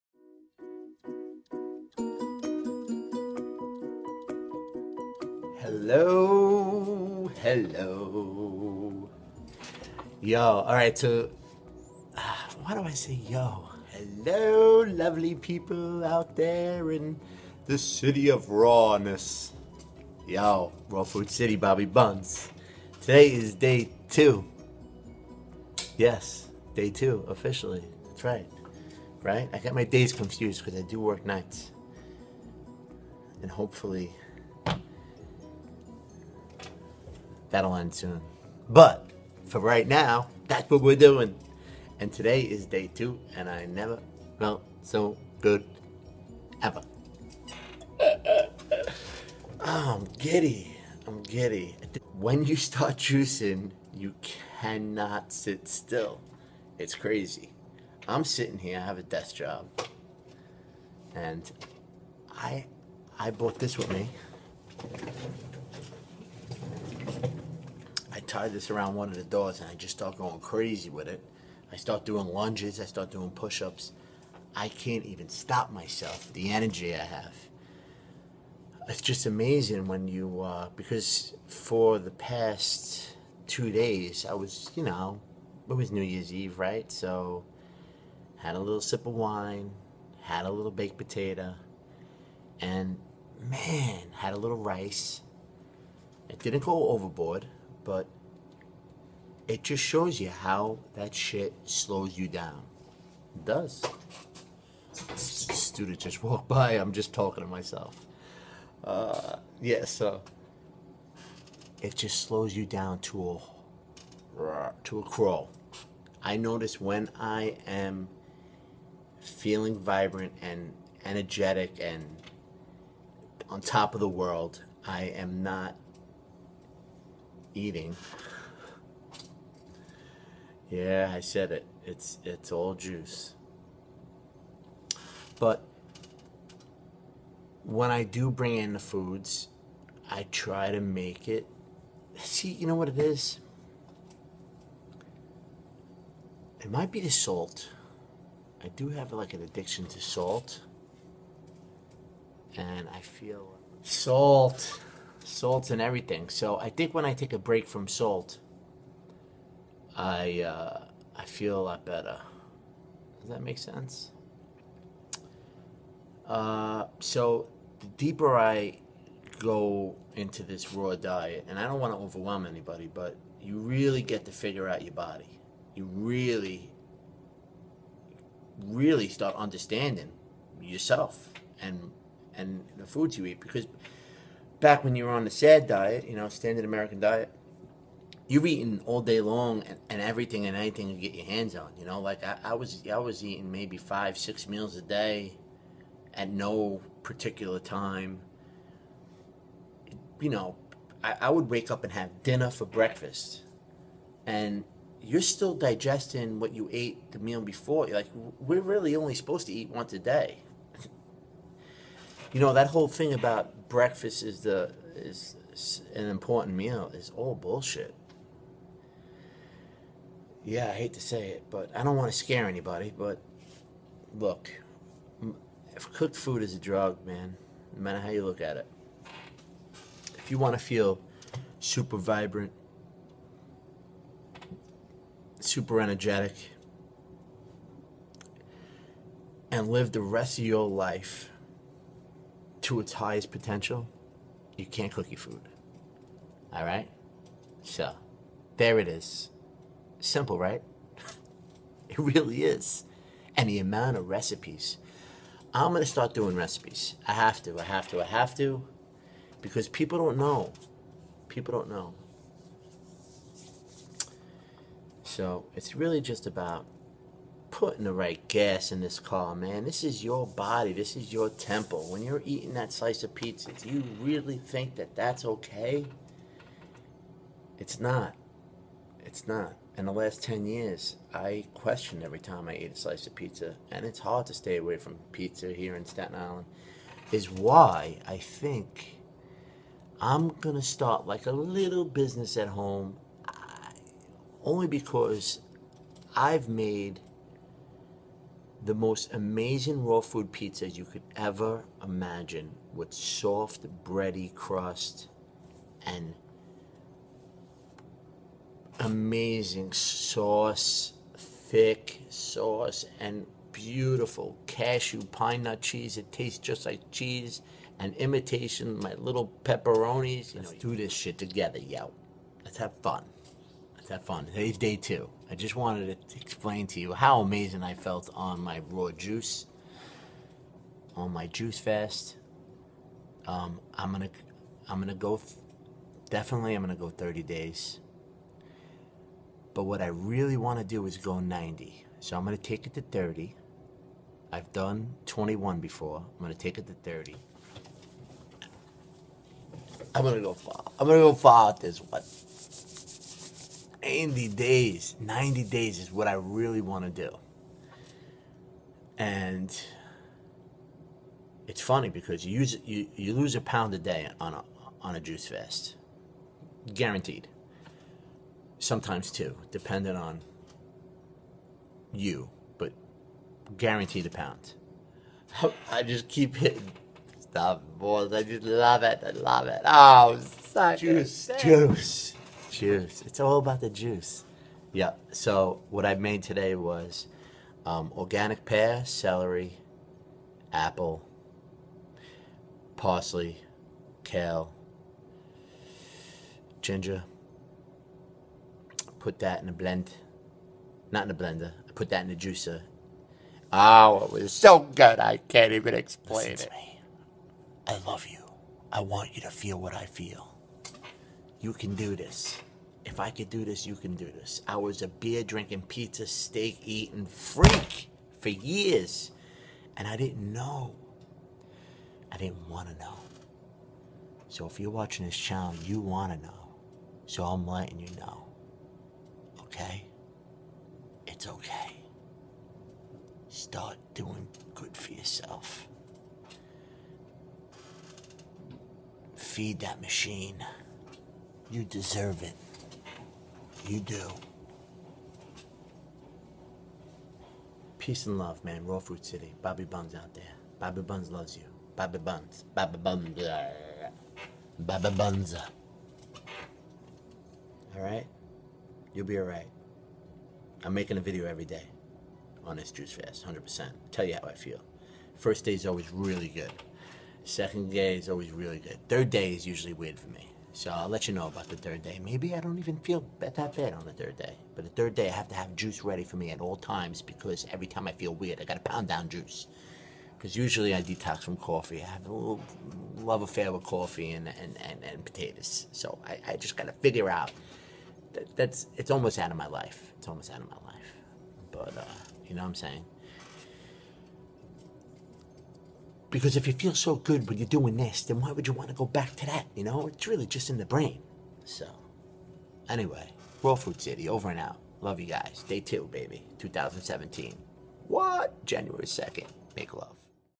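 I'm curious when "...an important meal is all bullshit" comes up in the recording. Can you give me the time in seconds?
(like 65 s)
215 s.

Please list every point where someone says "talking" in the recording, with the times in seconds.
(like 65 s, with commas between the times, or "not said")
107 s.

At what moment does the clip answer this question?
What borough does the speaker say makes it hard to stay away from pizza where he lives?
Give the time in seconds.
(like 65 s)
285 s.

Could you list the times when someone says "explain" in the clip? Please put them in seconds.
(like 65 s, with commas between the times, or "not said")
326 s, 405 s.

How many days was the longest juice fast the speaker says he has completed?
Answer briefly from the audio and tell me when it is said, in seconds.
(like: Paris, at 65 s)
21, at 345 s.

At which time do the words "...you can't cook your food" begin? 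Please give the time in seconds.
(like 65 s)
244 s.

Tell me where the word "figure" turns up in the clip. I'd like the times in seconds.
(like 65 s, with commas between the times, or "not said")
174 s, 486 s.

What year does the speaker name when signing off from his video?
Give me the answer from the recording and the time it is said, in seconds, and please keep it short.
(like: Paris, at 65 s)
2017, at 506 s.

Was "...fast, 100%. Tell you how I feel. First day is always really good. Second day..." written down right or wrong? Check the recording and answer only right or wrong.
right.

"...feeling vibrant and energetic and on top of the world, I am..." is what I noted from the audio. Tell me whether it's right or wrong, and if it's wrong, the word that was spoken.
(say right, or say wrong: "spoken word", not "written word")
right.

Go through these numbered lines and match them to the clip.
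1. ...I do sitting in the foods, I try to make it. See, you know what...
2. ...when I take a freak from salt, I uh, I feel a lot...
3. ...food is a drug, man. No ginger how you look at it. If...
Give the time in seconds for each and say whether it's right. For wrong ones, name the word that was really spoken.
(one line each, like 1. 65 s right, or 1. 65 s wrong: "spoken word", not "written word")
1. 137 s wrong: "bring", not "sitting"
2. 156 s wrong: "break", not "freak"
3. 226 s wrong: "matter", not "ginger".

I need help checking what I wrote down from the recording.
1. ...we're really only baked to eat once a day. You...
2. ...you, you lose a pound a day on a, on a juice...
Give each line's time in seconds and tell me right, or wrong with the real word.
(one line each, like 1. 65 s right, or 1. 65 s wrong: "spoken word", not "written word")
1. 208 s wrong: "supposed", not "baked"
2. 362 s right.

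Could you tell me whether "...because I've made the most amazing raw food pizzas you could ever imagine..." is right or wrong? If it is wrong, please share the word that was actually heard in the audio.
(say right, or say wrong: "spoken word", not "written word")
right.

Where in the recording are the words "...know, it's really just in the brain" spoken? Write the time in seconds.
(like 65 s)
499 s.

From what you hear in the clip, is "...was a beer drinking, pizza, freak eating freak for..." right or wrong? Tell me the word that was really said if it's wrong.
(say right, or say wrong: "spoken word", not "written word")
wrong: "steak", not "freak".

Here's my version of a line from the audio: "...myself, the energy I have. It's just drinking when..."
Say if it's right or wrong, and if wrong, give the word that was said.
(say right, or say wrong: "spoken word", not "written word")
wrong: "amazing", not "drinking".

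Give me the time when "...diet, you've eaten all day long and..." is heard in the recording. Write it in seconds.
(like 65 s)
186 s.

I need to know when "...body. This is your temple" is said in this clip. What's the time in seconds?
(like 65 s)
270 s.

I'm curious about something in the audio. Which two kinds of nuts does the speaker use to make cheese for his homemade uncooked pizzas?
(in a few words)
cashew pine nut.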